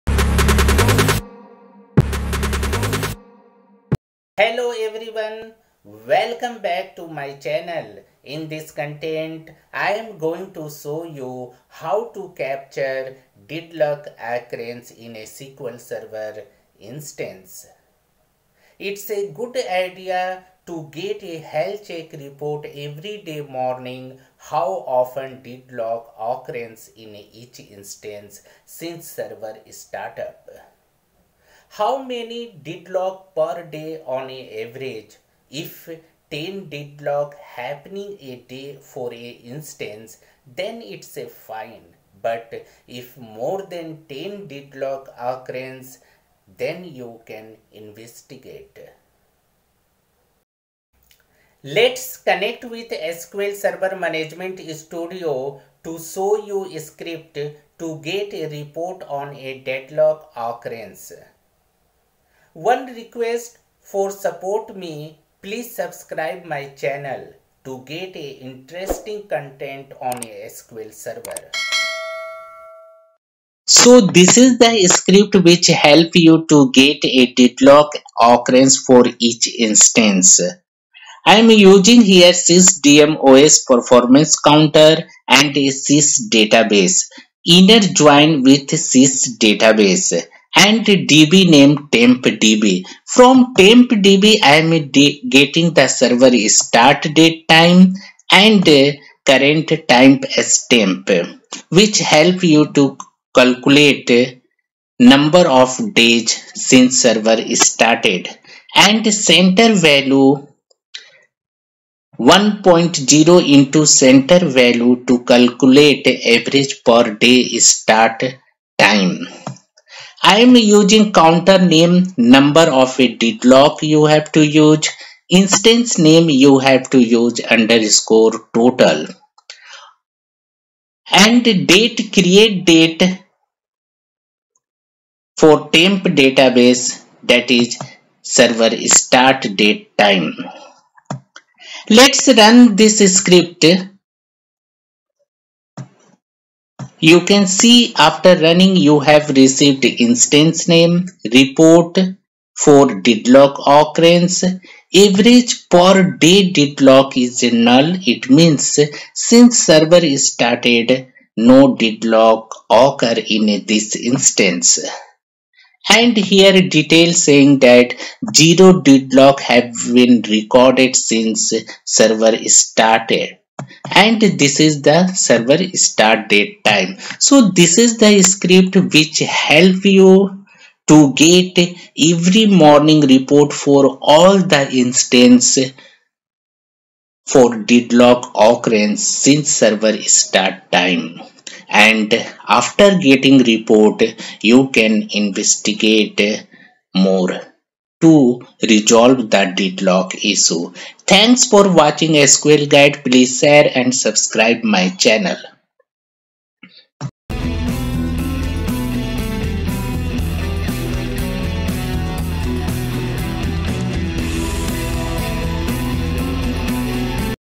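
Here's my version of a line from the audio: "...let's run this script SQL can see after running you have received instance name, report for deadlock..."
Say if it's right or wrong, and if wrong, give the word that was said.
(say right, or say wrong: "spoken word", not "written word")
wrong: "You", not "SQL".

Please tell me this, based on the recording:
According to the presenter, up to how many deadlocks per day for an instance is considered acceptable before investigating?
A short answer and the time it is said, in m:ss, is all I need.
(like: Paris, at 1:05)
10, at 0:36.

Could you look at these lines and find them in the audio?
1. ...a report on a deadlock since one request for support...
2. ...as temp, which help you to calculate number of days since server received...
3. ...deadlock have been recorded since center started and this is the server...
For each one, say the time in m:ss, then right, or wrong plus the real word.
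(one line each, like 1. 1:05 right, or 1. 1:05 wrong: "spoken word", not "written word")
1. 0:58 wrong: "occurrence", not "since"
2. 1:40 wrong: "started", not "received"
3. 2:48 wrong: "server", not "center".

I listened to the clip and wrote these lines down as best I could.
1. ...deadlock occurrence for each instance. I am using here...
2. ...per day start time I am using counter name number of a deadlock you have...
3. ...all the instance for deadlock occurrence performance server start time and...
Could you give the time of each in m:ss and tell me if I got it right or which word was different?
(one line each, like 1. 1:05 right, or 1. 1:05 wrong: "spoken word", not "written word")
1. 1:17 right
2. 1:56 right
3. 3:04 wrong: "since", not "performance".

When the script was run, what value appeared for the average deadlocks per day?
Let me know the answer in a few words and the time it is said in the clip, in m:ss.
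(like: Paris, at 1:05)
null, at 2:37.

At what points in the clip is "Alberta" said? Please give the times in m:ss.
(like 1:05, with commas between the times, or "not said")
not said.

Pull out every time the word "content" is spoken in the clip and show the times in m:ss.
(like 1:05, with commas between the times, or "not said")
0:08, 1:09.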